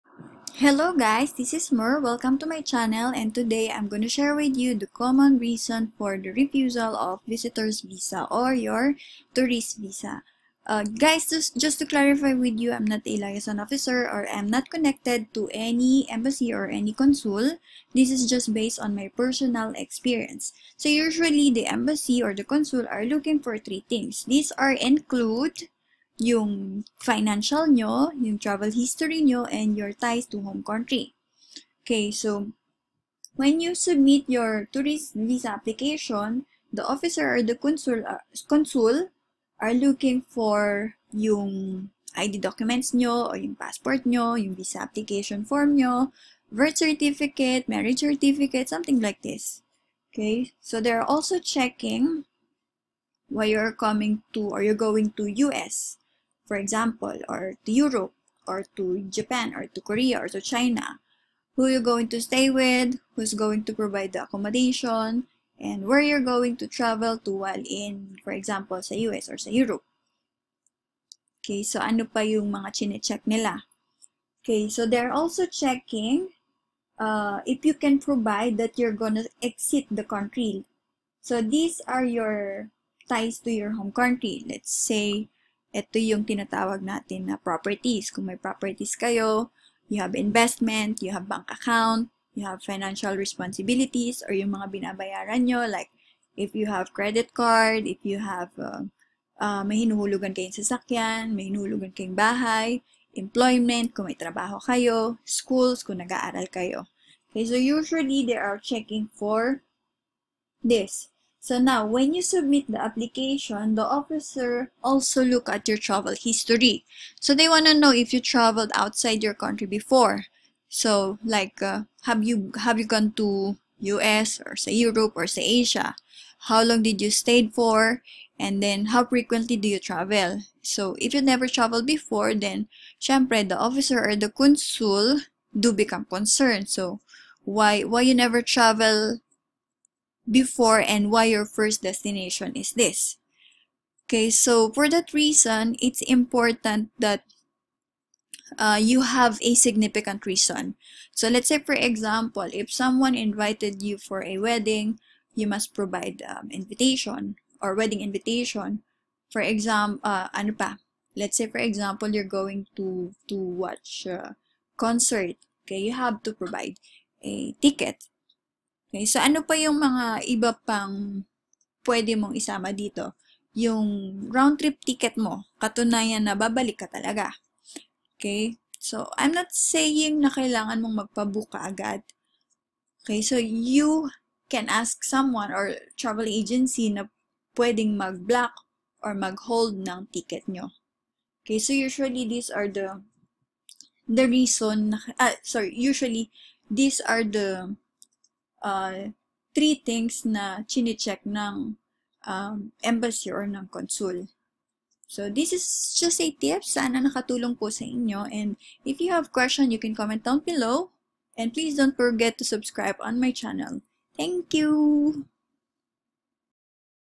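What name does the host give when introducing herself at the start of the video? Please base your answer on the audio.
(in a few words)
Mur.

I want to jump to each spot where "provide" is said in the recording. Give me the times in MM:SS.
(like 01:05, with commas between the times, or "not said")
01:03, 01:17, 02:35, 02:46.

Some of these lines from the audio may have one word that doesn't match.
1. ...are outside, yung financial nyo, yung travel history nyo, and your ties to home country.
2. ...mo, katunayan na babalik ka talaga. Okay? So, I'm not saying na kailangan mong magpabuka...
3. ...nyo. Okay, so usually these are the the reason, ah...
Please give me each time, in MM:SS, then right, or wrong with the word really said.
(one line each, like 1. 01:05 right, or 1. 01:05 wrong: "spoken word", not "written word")
1. 00:24 wrong: "include", not "outside"
2. 02:55 right
3. 03:10 right.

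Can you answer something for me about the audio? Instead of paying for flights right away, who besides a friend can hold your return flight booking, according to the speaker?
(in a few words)
travel agency.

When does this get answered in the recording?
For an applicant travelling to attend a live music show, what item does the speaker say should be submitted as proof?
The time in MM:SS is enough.
02:47.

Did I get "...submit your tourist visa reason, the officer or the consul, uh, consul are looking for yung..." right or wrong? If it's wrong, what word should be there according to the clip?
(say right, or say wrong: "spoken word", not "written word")
wrong: "application", not "reason".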